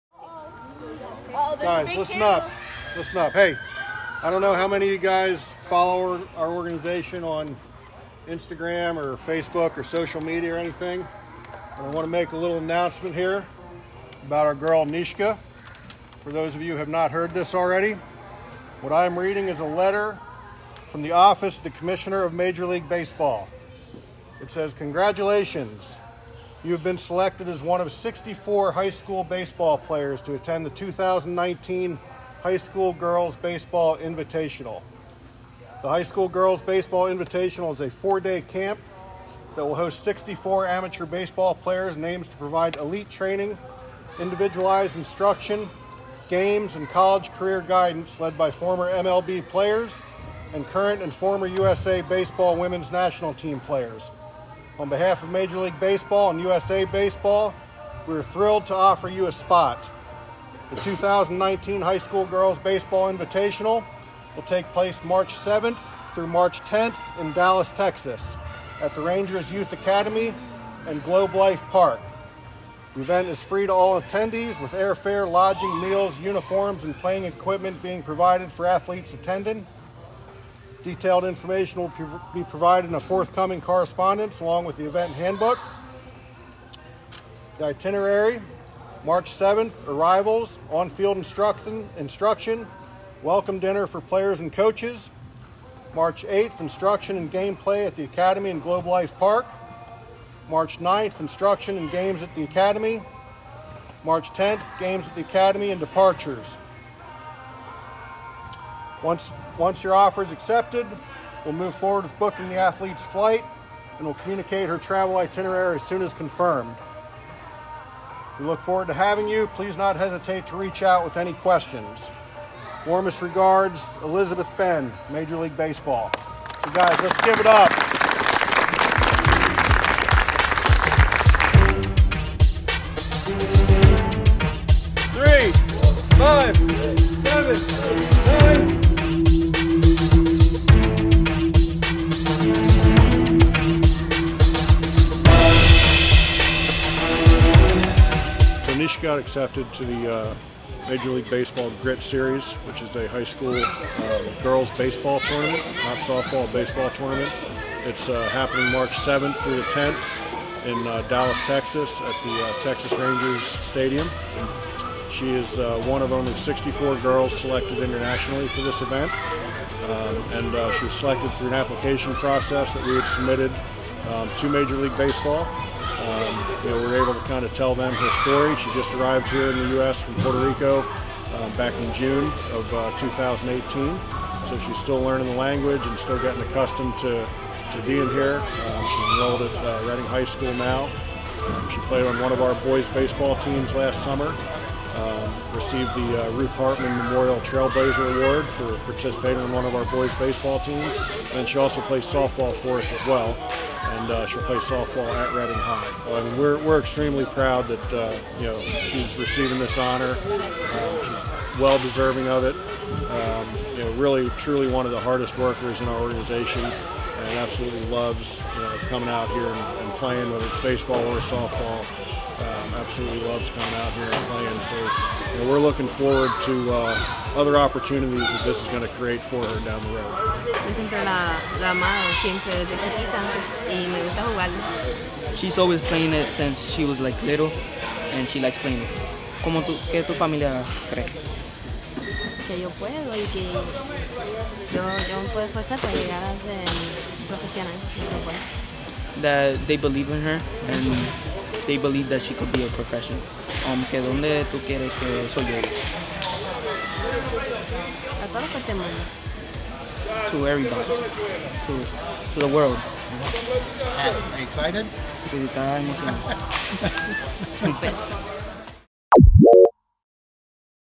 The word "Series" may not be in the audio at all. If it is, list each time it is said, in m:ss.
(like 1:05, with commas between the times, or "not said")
2:32.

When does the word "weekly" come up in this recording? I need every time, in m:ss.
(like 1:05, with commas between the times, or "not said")
not said.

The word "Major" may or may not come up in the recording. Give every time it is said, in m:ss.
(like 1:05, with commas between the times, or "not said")
0:22, 0:55, 2:05, 2:30, 2:54.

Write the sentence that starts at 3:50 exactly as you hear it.
Yo siempre la, la amado, siempre desde chiquita, y me gusta jugarlo.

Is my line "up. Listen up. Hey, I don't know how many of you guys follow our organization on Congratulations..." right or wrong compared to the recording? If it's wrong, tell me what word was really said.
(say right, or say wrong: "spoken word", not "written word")
wrong: "Instagram", not "Congratulations".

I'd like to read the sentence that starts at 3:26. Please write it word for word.
And we're, we're extremely proud that uh, you know she's receiving this honor.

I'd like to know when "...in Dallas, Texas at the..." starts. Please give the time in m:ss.
1:07.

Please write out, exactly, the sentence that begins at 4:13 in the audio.
Um, que donde tú quieres que soy yo.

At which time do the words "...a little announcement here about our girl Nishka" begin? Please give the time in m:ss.
0:12.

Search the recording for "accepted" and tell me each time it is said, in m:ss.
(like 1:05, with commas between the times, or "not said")
1:50, 2:29.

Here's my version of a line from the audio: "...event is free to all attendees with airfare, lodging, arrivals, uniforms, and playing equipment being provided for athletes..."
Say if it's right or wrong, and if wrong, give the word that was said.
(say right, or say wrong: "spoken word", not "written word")
wrong: "meals", not "arrivals".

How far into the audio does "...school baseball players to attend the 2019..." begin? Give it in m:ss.
0:28.